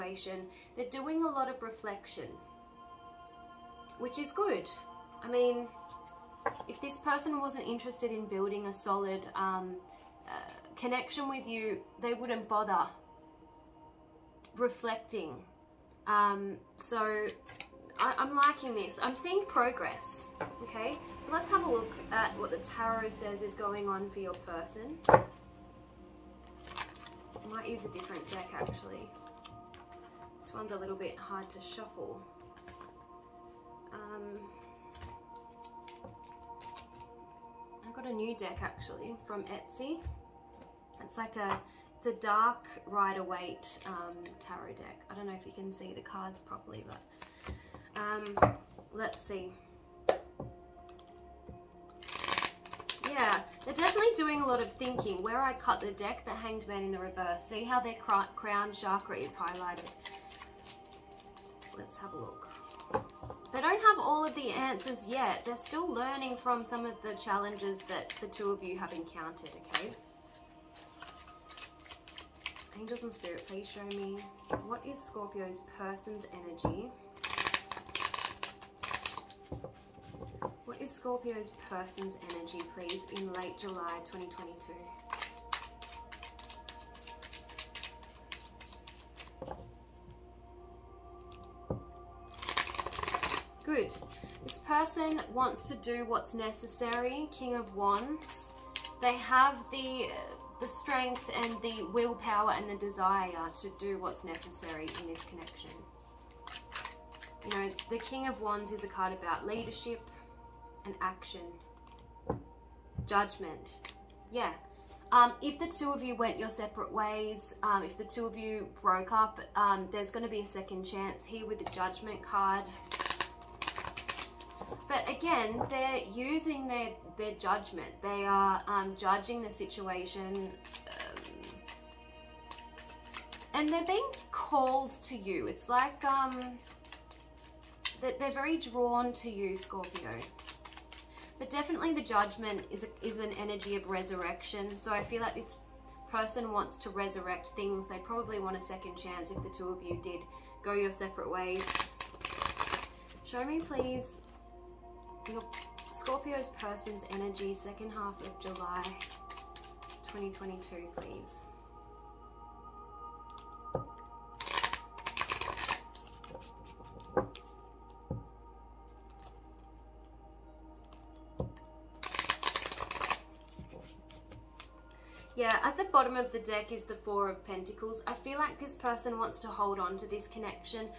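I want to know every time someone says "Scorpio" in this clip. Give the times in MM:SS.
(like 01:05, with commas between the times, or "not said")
01:15, 01:20, 02:19, 02:35.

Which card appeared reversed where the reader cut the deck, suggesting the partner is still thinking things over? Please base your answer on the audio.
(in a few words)
The Hanged Man.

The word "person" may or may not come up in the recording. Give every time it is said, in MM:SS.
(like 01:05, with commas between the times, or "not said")
00:06, 00:24, 01:15, 01:21, 01:34, 02:26, 02:36, 02:58.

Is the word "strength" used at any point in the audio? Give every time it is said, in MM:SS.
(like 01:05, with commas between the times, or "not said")
01:40.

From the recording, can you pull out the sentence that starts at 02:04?
But again, they're using their, their judgment.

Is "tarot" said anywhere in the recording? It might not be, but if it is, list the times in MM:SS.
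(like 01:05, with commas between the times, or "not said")
00:22, 00:44.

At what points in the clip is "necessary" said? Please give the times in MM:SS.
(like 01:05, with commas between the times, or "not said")
01:36, 01:44.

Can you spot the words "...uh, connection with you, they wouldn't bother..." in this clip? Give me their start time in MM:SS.
00:10.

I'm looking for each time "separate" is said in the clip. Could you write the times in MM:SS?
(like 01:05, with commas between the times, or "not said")
01:56, 02:30.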